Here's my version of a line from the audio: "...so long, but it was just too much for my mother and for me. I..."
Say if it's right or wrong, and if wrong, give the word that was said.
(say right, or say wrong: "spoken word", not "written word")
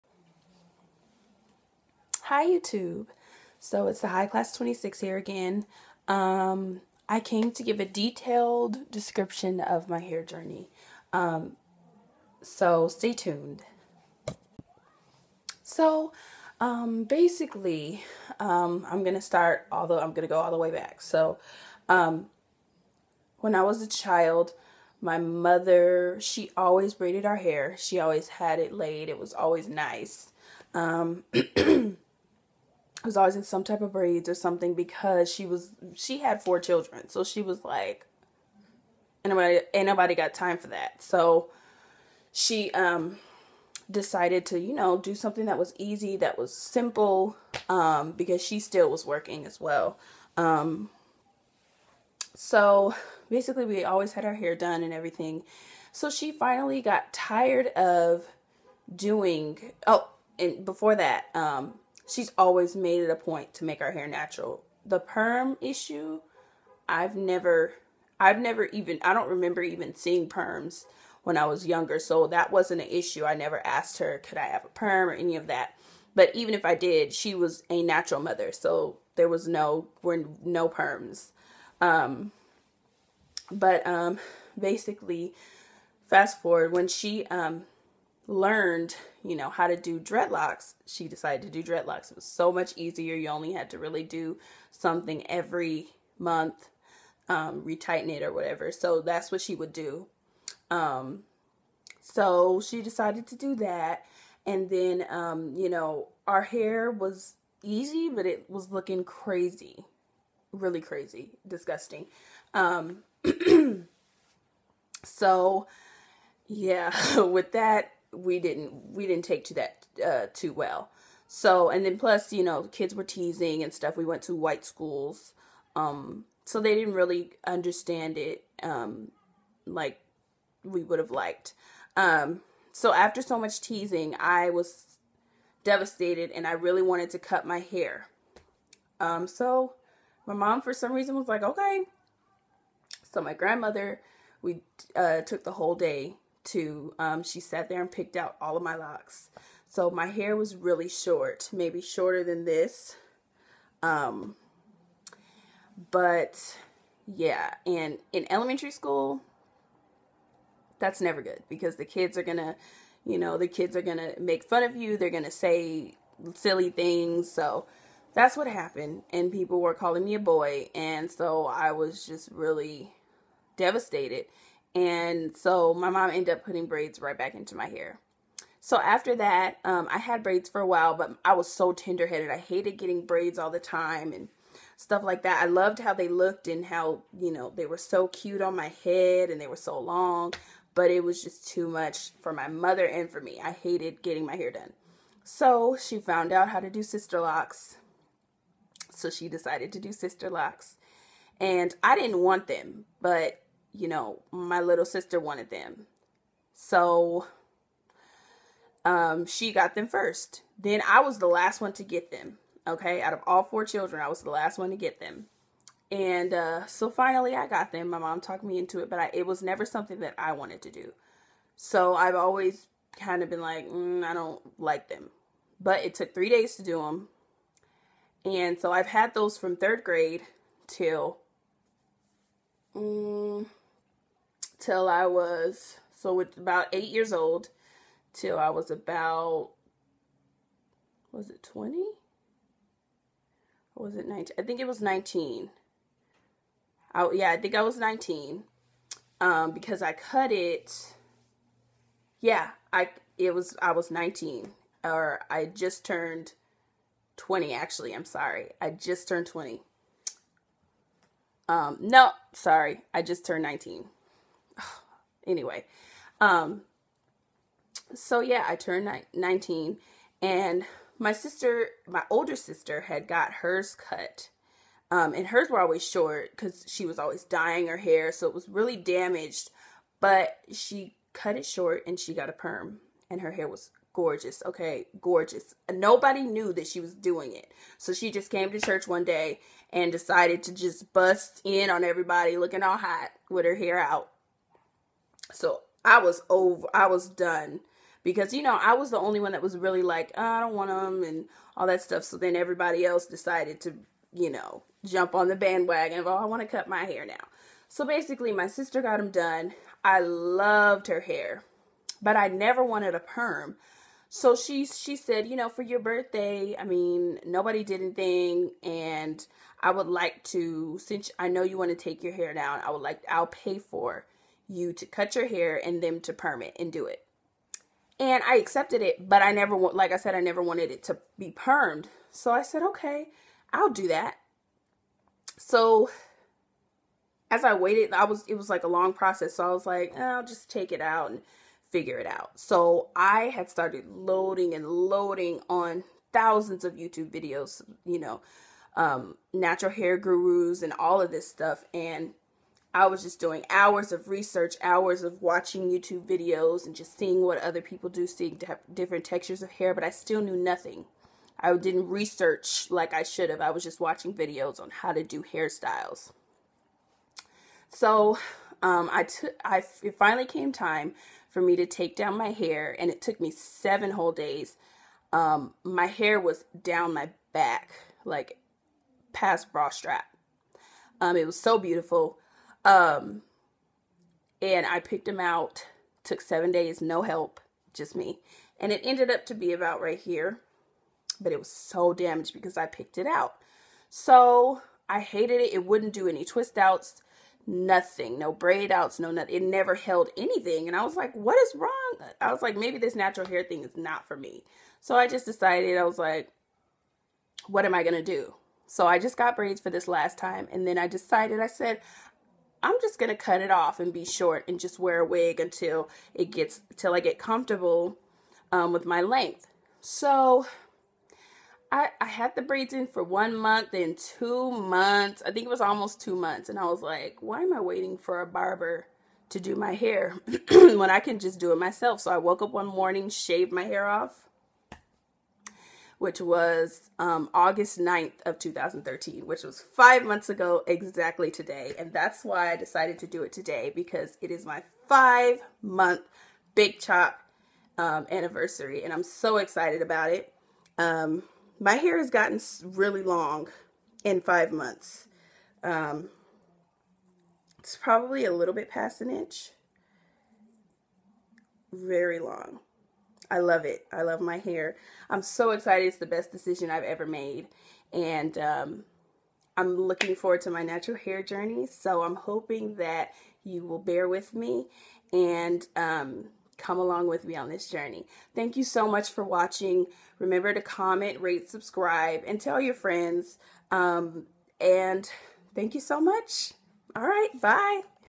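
right.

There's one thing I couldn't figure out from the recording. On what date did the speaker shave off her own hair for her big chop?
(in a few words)
August 9, 2013.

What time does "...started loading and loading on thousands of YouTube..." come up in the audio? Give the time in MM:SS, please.
05:43.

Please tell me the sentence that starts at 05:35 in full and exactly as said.
So as I waited, I was, it was like a long process.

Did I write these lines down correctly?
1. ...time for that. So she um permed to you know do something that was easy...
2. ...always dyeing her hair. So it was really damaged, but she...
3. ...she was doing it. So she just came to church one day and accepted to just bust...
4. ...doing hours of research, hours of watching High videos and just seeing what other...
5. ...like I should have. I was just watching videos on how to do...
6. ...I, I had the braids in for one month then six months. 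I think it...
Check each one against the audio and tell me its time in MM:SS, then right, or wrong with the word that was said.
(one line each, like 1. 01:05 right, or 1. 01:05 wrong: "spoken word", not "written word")
1. 00:40 wrong: "decided", not "permed"
2. 04:36 right
3. 04:46 wrong: "decided", not "accepted"
4. 05:53 wrong: "YouTube", not "High"
5. 06:02 right
6. 07:01 wrong: "two", not "six".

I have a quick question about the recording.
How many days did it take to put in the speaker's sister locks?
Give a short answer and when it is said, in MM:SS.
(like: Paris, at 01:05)
3, at 03:46.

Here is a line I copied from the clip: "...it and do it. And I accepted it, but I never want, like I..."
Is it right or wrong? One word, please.
right.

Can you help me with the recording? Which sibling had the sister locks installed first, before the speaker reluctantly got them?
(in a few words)
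little sister.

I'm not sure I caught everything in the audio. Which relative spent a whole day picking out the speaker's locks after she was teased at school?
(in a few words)
grandmother.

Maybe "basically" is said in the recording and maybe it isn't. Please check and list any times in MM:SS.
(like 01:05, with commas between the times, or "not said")
00:17, 00:53, 01:24, 05:07.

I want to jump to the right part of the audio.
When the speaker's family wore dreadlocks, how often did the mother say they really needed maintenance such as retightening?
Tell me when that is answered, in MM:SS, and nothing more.
01:35.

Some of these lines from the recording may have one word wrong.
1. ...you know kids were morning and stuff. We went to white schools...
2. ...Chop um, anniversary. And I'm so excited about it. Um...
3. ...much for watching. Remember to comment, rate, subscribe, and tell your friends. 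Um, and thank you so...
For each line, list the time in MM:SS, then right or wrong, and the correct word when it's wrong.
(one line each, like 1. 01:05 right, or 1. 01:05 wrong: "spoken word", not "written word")
1. 02:02 wrong: "teasing", not "morning"
2. 07:26 right
3. 07:58 right.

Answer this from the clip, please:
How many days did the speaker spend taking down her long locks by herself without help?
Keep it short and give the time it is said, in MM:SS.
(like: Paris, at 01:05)
7, at 06:13.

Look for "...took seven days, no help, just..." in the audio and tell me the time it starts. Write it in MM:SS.
06:26.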